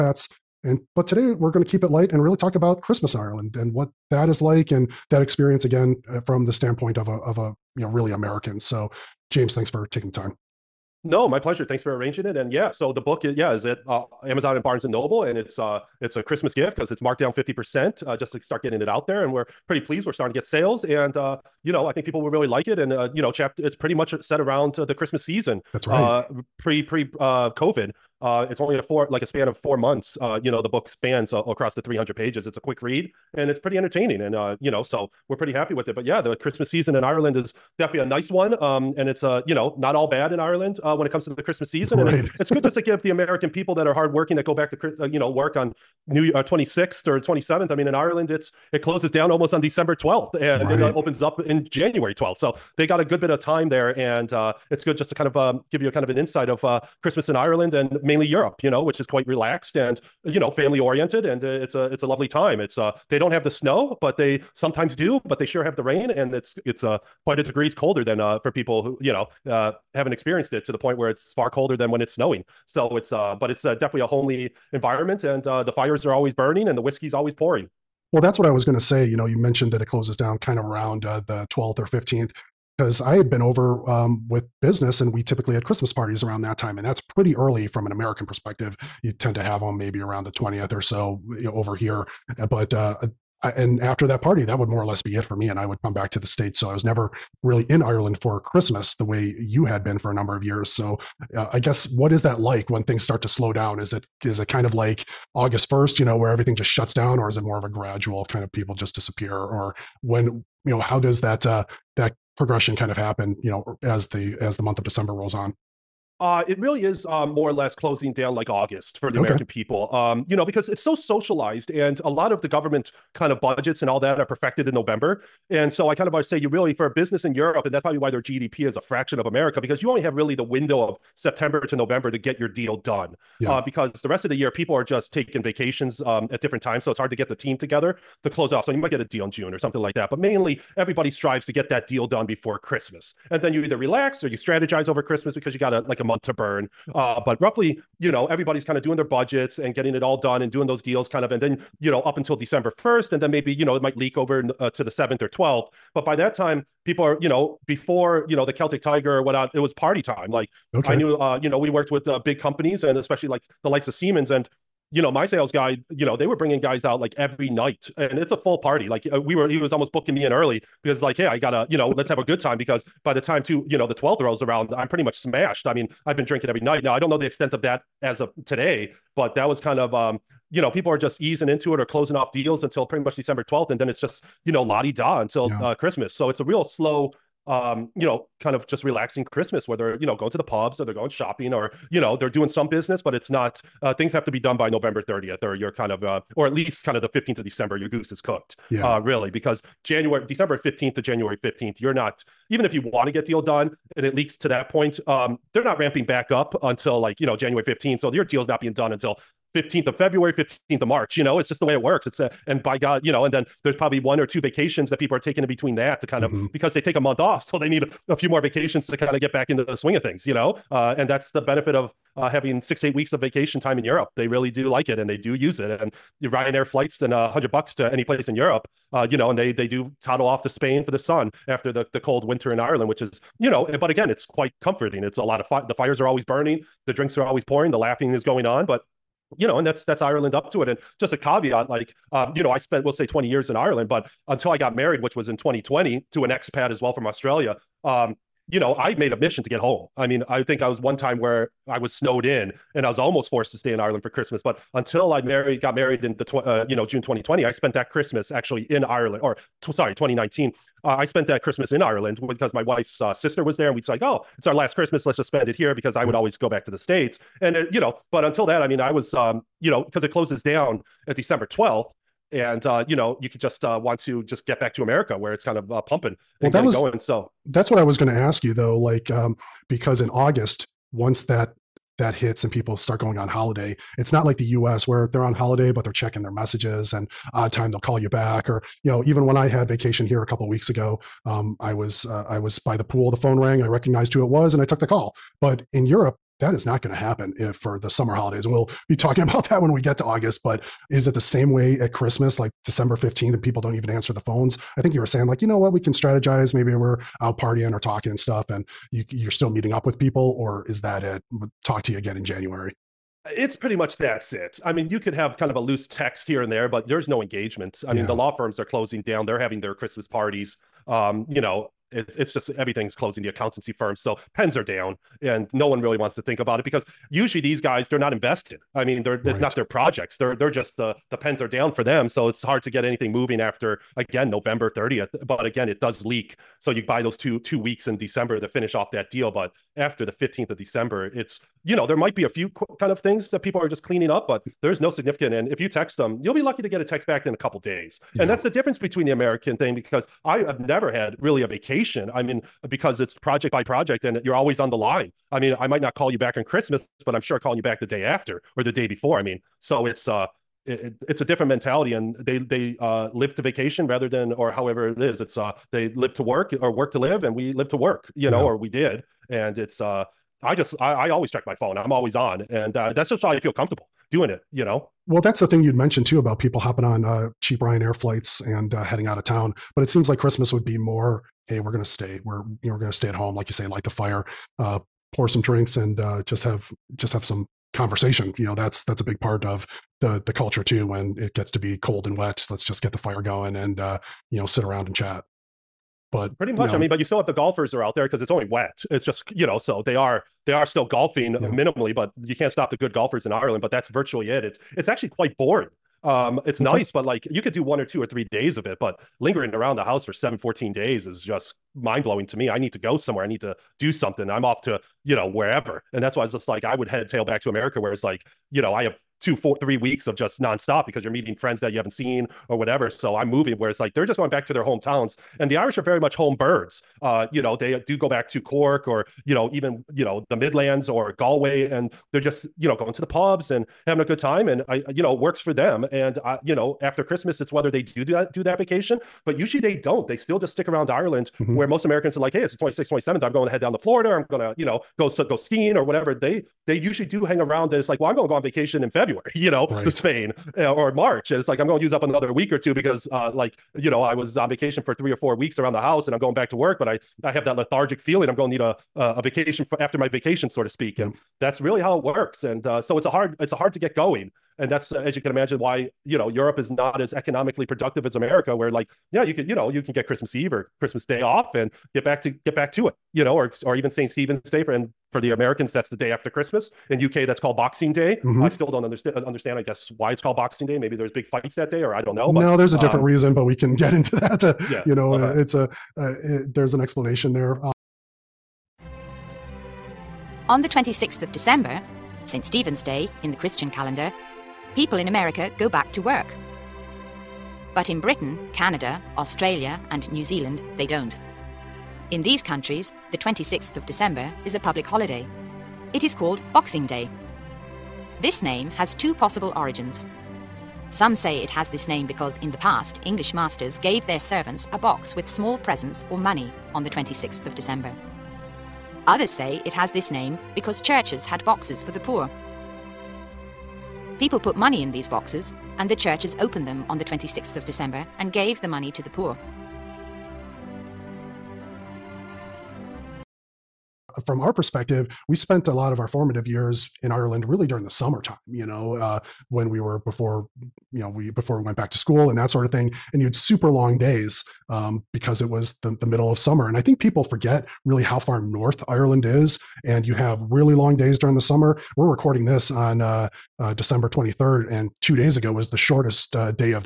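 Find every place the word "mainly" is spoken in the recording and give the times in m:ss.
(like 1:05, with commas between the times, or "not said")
0:58, 2:20.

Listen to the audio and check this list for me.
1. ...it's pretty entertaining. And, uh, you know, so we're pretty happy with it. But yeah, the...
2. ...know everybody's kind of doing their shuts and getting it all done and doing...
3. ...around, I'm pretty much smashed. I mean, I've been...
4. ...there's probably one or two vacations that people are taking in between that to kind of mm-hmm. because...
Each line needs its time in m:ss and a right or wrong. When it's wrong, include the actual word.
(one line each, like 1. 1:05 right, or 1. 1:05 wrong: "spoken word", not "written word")
1. 0:33 right
2. 2:28 wrong: "budgets", not "shuts"
3. 2:54 right
4. 3:33 right.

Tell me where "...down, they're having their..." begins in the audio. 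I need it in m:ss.
5:19.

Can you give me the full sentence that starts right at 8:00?
Maybe there's big fights that day or I don't know.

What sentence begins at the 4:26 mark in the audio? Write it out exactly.
always go back to the states, and uh, you know.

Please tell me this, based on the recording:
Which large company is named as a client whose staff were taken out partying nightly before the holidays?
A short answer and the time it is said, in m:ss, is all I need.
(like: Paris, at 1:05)
Siemens, at 2:43.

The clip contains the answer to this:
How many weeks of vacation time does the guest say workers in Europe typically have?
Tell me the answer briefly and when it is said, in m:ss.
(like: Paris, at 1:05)
6 to 8 weeks, at 3:42.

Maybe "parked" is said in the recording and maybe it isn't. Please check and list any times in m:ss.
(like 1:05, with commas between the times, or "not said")
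not said.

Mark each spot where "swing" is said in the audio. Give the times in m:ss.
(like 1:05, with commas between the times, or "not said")
3:39.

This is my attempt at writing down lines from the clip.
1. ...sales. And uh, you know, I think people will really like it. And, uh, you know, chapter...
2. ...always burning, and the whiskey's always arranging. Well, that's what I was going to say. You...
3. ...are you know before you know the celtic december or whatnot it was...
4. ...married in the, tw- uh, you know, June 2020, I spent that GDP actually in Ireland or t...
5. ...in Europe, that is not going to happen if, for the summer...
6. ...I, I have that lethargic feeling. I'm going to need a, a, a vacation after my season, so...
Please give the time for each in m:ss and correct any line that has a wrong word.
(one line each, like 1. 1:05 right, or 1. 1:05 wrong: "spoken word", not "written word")
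1. 0:20 right
2. 1:16 wrong: "pouring", not "arranging"
3. 2:37 wrong: "tiger", not "december"
4. 4:15 wrong: "Christmas", not "GDP"
5. 4:55 right
6. 7:36 wrong: "vacation", not "season".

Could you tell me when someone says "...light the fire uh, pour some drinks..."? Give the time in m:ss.
6:23.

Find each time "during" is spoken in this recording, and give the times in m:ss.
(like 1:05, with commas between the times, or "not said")
8:57, 9:11.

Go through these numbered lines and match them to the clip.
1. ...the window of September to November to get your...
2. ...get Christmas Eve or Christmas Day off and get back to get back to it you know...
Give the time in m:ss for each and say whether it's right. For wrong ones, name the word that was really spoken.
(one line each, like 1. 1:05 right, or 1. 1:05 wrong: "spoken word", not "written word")
1. 2:10 right
2. 7:49 right.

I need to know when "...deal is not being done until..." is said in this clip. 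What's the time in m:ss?
3:28.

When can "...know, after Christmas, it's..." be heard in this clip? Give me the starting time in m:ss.
7:16.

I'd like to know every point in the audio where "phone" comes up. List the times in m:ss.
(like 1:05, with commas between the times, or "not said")
4:53, 5:04, 6:11.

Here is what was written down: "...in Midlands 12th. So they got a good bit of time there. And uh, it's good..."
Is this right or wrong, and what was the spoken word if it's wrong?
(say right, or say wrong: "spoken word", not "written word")
wrong: "January", not "Midlands".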